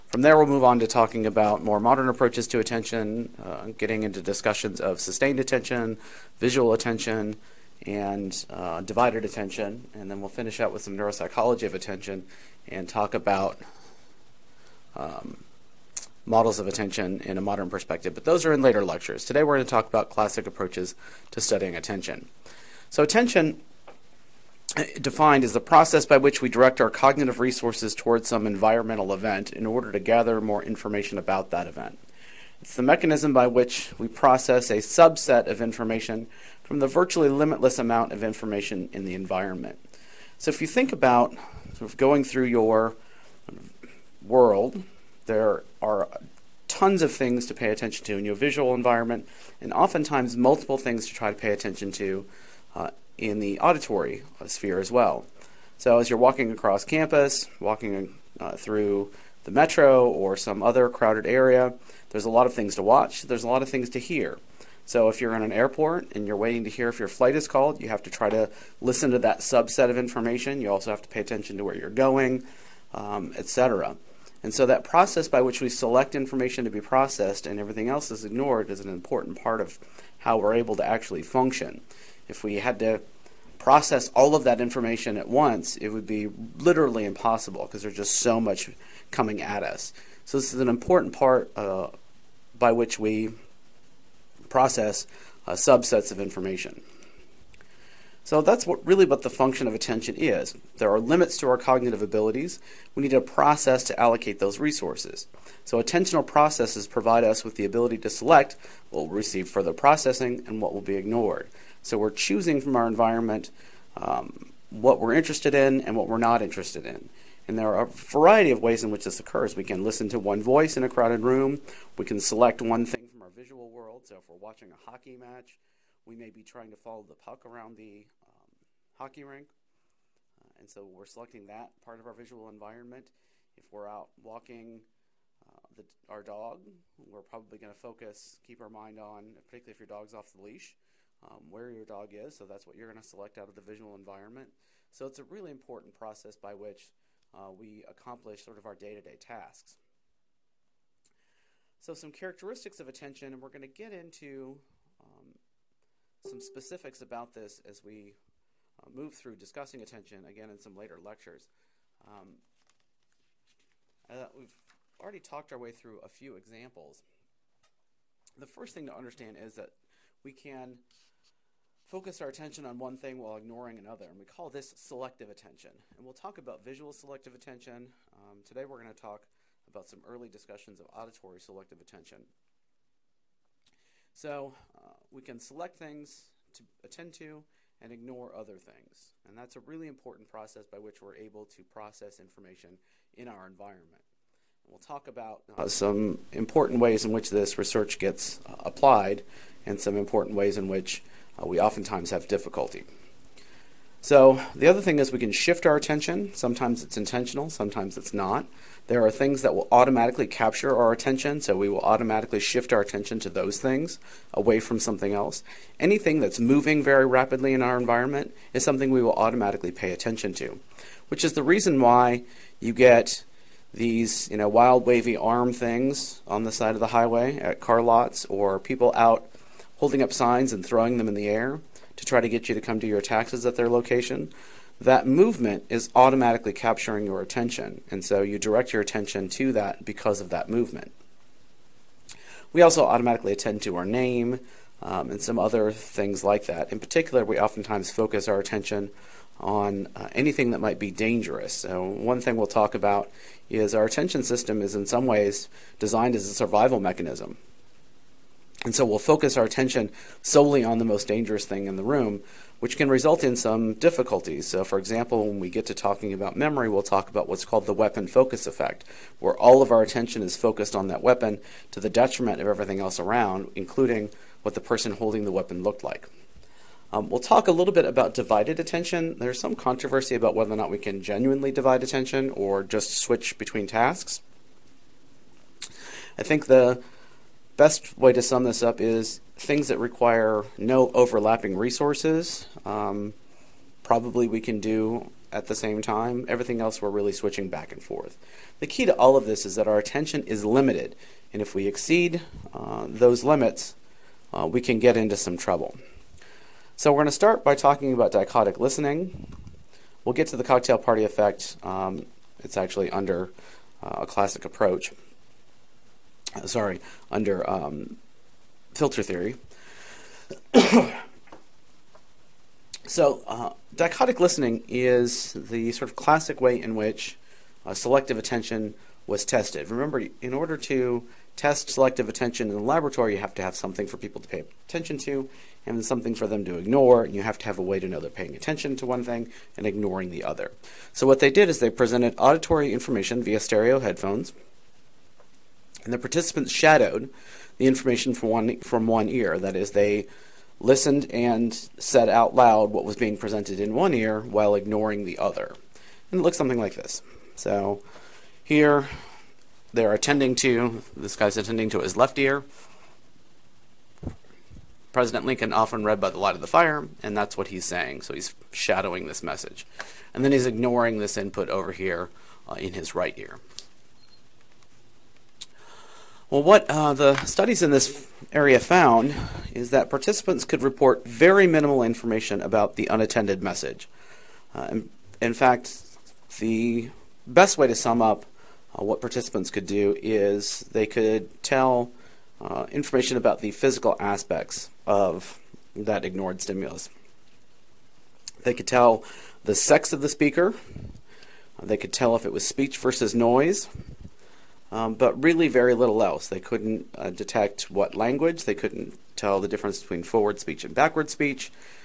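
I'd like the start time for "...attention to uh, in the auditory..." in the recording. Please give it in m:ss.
0:51.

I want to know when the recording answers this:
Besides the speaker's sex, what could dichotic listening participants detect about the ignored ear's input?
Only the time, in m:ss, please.
6:42.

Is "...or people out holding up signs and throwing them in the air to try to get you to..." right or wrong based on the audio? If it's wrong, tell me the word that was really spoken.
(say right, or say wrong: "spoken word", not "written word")
right.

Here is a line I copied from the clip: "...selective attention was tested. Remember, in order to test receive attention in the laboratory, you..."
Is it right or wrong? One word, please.
wrong.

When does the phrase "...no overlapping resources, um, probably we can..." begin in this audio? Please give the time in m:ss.
4:50.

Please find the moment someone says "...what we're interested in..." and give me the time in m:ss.
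1:54.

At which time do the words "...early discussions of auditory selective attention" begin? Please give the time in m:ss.
3:00.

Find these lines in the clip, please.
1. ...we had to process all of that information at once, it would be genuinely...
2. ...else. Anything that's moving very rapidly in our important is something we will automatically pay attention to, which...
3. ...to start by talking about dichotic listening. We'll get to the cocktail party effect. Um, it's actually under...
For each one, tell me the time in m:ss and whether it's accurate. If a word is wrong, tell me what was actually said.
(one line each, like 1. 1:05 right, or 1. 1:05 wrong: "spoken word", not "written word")
1. 1:22 wrong: "literally", not "genuinely"
2. 3:35 wrong: "environment", not "important"
3. 5:07 right.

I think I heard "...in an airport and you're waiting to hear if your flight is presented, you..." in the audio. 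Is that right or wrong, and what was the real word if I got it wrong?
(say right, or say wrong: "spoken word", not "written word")
wrong: "called", not "presented".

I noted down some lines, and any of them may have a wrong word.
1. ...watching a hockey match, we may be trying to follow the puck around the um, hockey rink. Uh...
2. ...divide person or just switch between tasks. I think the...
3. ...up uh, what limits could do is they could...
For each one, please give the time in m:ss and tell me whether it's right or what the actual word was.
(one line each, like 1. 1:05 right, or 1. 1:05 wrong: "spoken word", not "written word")
1. 2:04 right
2. 4:41 wrong: "attention", not "person"
3. 6:28 wrong: "participants", not "limits".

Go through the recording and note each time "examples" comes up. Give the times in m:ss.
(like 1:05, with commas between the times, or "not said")
2:46, 4:24.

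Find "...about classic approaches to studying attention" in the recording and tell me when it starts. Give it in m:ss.
0:19.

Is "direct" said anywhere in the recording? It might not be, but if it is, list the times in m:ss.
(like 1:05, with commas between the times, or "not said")
0:26, 3:58.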